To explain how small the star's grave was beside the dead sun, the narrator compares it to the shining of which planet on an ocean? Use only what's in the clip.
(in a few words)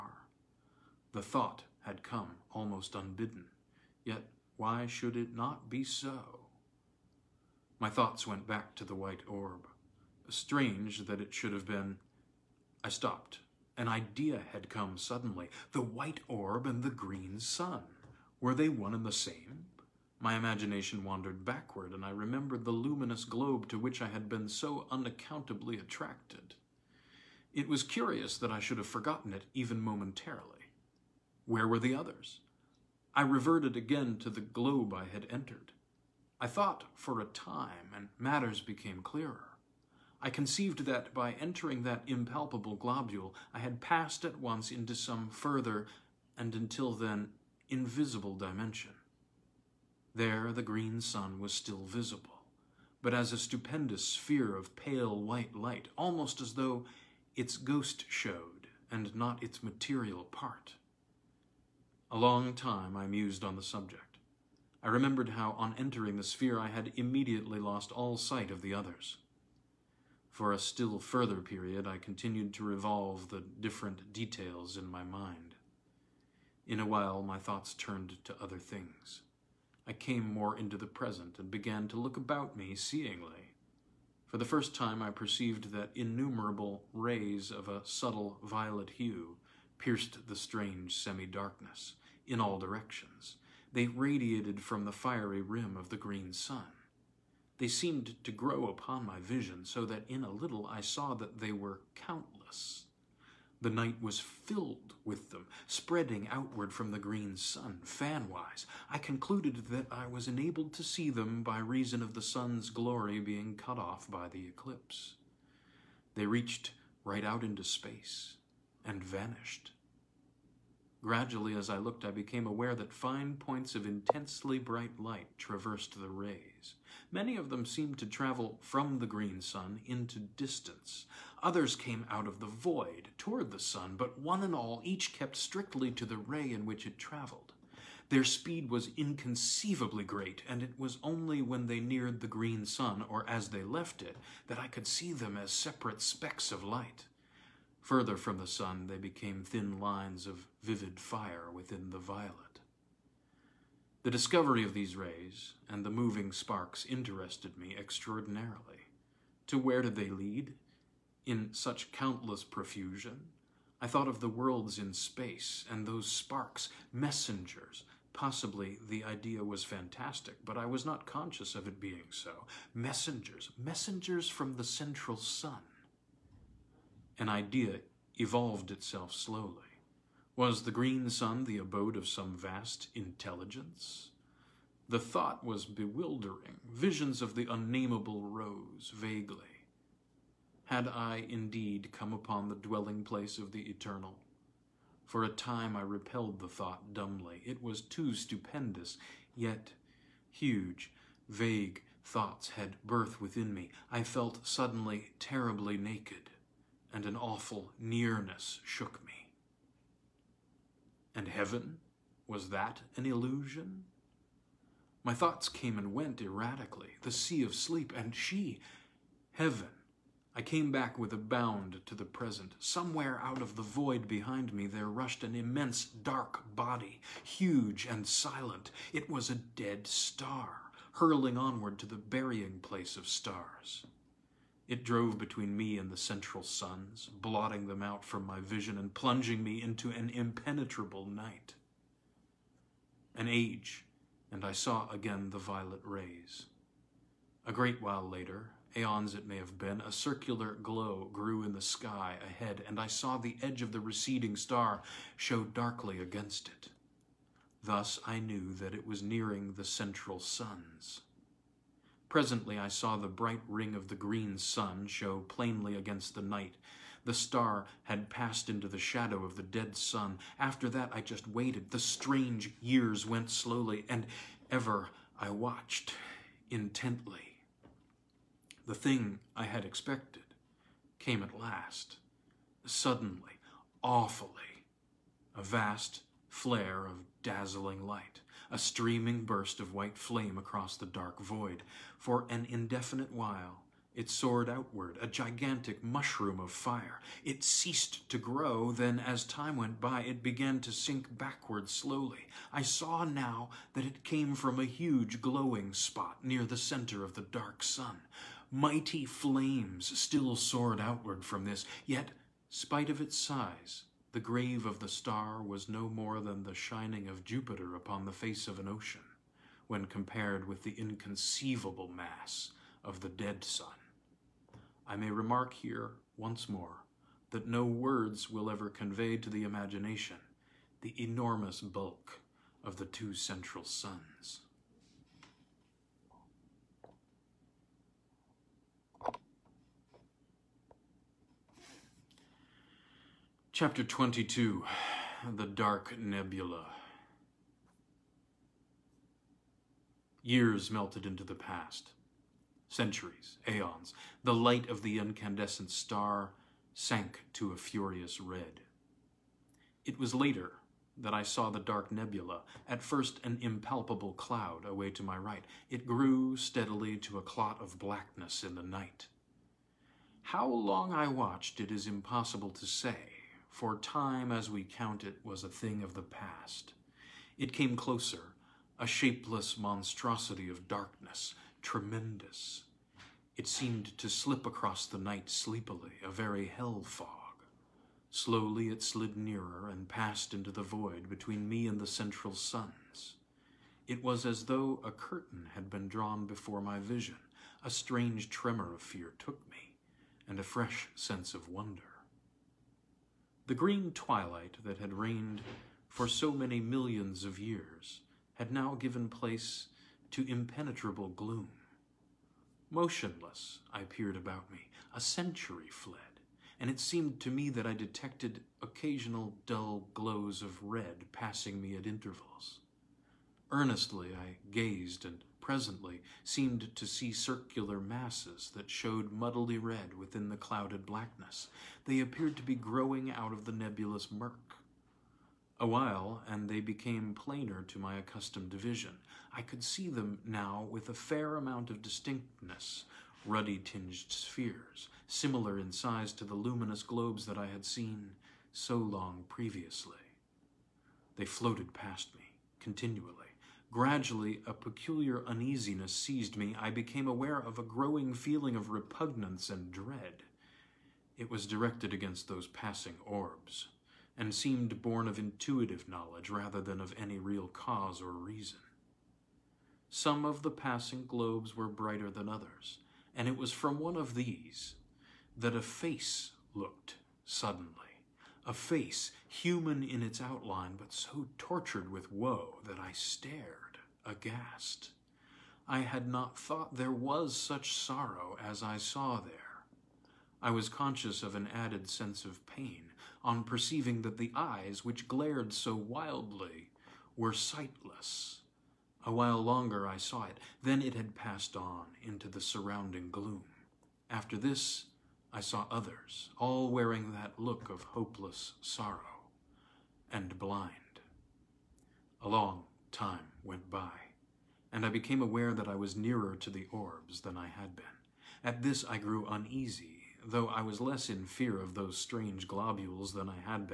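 Jupiter.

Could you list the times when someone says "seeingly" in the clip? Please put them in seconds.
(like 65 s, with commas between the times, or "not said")
82 s.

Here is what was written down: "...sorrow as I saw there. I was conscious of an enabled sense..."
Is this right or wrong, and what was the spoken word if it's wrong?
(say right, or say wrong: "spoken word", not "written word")
wrong: "added", not "enabled".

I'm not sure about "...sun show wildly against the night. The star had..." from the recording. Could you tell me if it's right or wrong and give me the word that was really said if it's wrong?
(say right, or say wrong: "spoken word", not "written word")
wrong: "plainly", not "wildly".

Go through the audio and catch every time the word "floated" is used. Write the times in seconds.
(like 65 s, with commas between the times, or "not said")
451 s.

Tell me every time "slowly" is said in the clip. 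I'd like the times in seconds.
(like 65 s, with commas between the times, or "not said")
179 s, 273 s, 301 s, 388 s.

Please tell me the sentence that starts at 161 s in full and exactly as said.
In such countless profusion, I thought of the worlds in space and those sparks, messengers.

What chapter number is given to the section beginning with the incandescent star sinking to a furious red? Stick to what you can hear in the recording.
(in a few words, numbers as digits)
22.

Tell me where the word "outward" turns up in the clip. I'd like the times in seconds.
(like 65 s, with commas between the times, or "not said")
106 s, 294 s, 310 s.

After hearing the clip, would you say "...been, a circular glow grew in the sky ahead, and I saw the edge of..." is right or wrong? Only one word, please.
right.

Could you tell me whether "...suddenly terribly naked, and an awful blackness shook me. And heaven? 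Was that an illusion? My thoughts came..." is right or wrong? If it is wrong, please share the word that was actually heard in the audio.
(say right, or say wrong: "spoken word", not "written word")
wrong: "nearness", not "blackness".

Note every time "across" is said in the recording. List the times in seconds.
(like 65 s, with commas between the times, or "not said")
290 s, 384 s.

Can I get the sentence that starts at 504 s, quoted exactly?
After this, I saw others, all wearing that look of hopeless sorrow and blind.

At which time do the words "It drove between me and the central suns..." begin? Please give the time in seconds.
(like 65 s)
234 s.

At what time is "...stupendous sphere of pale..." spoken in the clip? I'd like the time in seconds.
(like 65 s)
53 s.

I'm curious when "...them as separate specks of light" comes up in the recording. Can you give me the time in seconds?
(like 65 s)
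145 s.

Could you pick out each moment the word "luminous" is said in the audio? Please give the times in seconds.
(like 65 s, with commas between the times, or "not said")
22 s, 446 s.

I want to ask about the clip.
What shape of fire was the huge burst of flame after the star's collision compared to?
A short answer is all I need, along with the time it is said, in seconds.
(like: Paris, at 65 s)
A gigantic mushroom, at 295 s.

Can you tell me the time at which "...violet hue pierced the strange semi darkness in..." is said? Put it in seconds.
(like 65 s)
88 s.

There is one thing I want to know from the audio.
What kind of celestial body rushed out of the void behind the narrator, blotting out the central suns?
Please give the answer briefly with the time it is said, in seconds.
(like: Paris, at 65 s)
A dead star, at 229 s.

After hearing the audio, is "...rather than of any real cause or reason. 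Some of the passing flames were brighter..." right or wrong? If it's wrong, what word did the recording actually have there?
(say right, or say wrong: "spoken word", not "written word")
wrong: "globes", not "flames".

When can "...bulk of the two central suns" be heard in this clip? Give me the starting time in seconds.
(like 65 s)
331 s.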